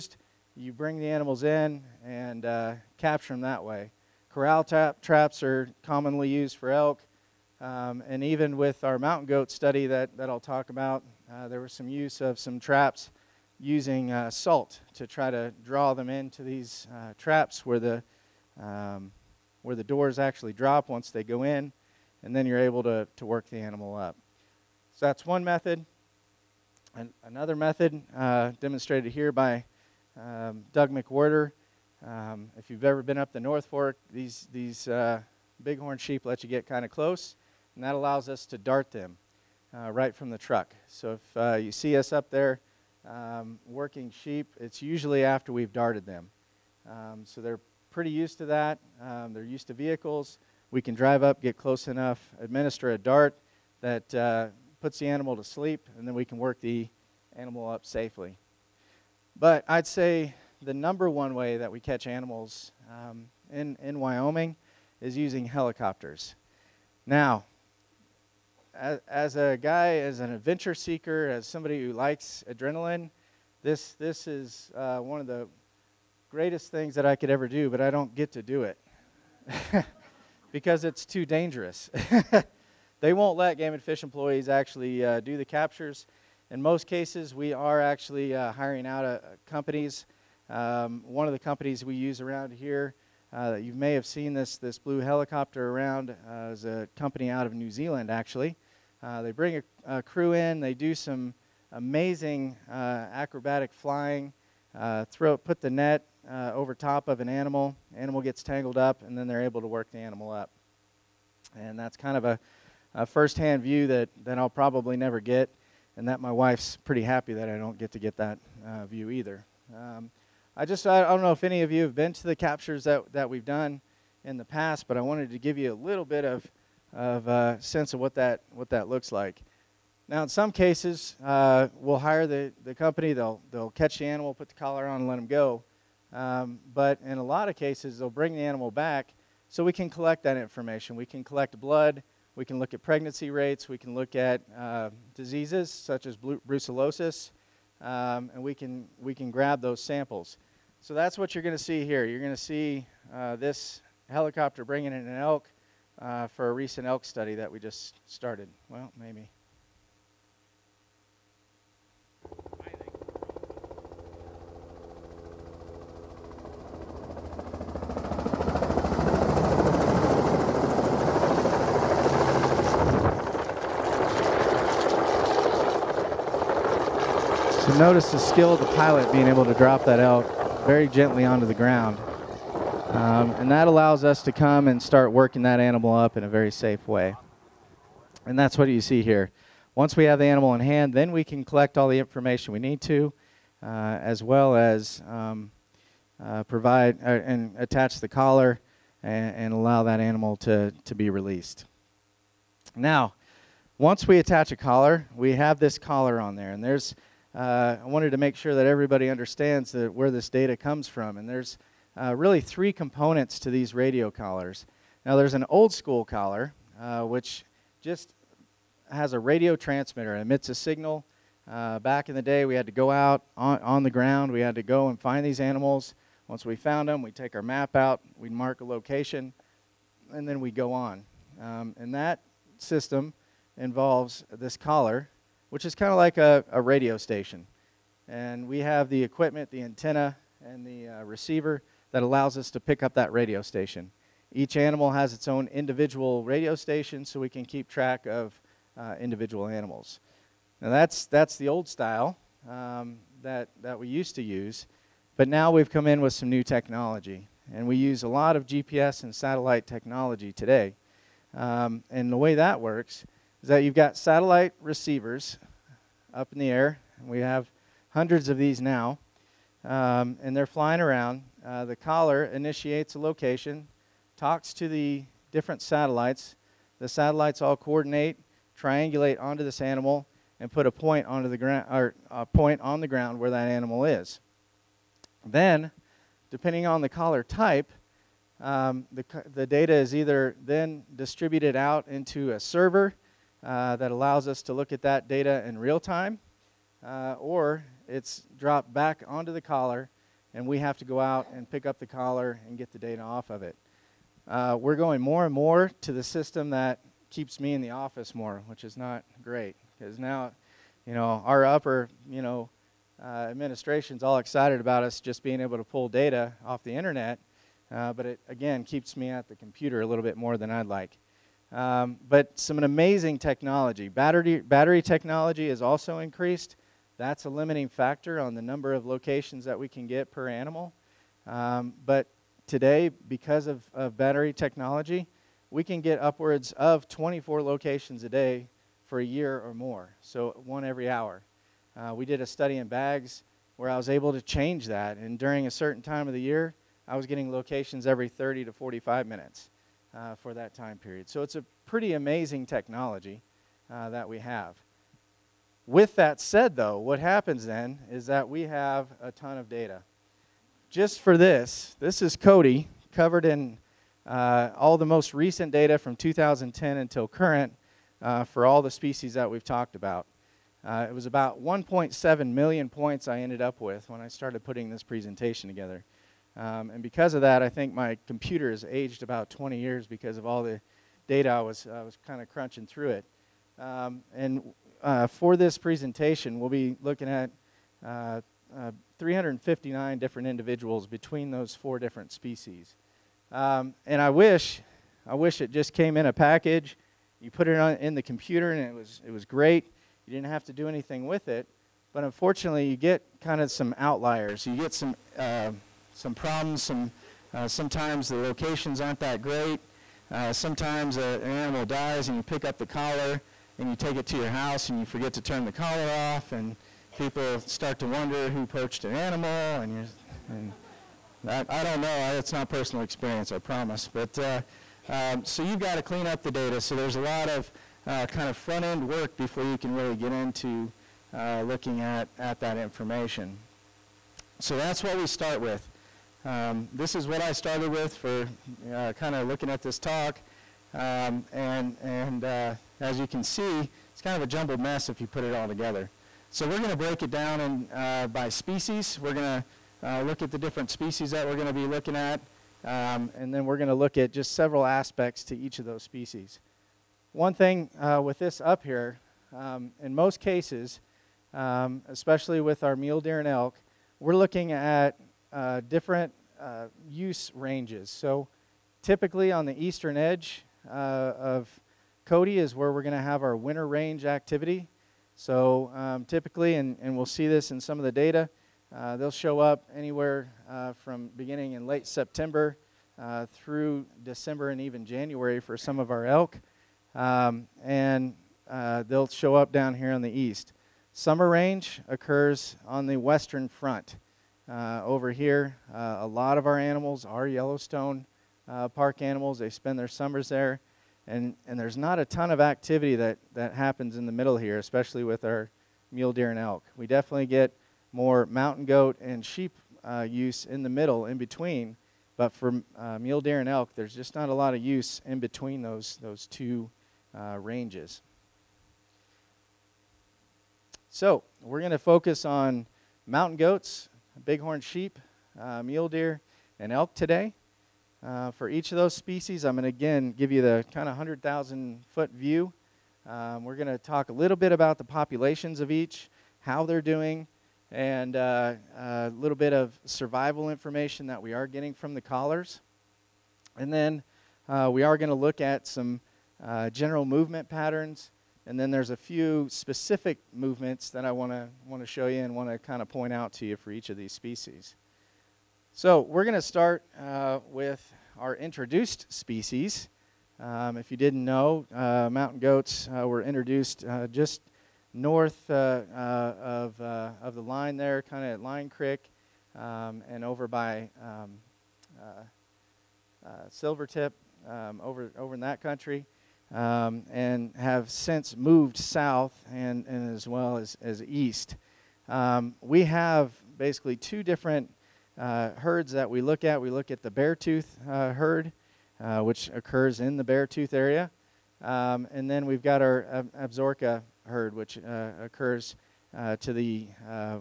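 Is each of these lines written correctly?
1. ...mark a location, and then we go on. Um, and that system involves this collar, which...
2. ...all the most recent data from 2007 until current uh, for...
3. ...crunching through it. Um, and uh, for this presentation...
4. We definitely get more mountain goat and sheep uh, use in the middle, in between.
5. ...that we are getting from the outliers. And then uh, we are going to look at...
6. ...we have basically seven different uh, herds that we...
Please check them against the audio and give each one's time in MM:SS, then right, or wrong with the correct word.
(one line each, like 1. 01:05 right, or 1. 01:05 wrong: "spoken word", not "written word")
1. 03:48 right
2. 06:04 wrong: "2010", not "2007"
3. 06:22 right
4. 08:26 right
5. 09:01 wrong: "collars", not "outliers"
6. 09:42 wrong: "two", not "seven".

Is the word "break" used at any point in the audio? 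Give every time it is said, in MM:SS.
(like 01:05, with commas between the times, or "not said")
07:26.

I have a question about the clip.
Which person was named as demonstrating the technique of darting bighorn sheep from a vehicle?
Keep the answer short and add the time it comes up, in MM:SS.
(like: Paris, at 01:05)
Doug McWhorter, at 00:30.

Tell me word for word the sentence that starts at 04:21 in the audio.
Um, and the way that works is that you've got satellite receivers up in the air.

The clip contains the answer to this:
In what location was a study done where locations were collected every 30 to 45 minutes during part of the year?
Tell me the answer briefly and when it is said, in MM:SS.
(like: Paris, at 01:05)
Baggs, at 05:42.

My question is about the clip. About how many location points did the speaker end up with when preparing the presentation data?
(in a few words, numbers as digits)
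1.7 million.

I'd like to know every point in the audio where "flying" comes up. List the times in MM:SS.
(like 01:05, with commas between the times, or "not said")
01:43, 04:30.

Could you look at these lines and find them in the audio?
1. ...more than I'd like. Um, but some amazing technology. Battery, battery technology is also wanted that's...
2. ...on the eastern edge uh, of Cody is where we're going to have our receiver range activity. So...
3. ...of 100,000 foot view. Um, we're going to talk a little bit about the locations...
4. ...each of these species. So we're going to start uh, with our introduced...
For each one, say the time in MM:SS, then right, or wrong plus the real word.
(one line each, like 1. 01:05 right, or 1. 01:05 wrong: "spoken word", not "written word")
1. 05:20 wrong: "increased", not "wanted"
2. 07:49 wrong: "winter", not "receiver"
3. 08:50 wrong: "populations", not "locations"
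4. 09:13 right.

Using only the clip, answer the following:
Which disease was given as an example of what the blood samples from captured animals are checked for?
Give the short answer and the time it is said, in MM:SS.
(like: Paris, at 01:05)
Brucellosis, at 02:26.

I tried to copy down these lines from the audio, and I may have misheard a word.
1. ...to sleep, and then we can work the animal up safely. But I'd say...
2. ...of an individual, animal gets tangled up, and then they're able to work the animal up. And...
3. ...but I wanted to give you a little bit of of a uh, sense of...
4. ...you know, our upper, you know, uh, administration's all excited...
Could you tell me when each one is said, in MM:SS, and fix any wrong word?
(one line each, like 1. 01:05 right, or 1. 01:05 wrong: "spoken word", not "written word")
1. 00:55 right
2. 01:47 wrong: "animal", not "individual"
3. 02:04 right
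4. 05:10 right.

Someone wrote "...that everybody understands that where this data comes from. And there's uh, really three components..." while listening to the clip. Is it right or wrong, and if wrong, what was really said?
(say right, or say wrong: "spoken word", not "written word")
right.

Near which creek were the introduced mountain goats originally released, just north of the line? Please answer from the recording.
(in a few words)
Line Creek.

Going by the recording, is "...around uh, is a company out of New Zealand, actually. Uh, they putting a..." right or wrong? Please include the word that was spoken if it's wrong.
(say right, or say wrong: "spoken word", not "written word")
wrong: "bring", not "putting".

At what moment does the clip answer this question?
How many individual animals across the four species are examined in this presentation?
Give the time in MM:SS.
06:28.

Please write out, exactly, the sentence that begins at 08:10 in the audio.
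Summer range occurs on the western front.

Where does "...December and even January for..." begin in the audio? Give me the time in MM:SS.
08:04.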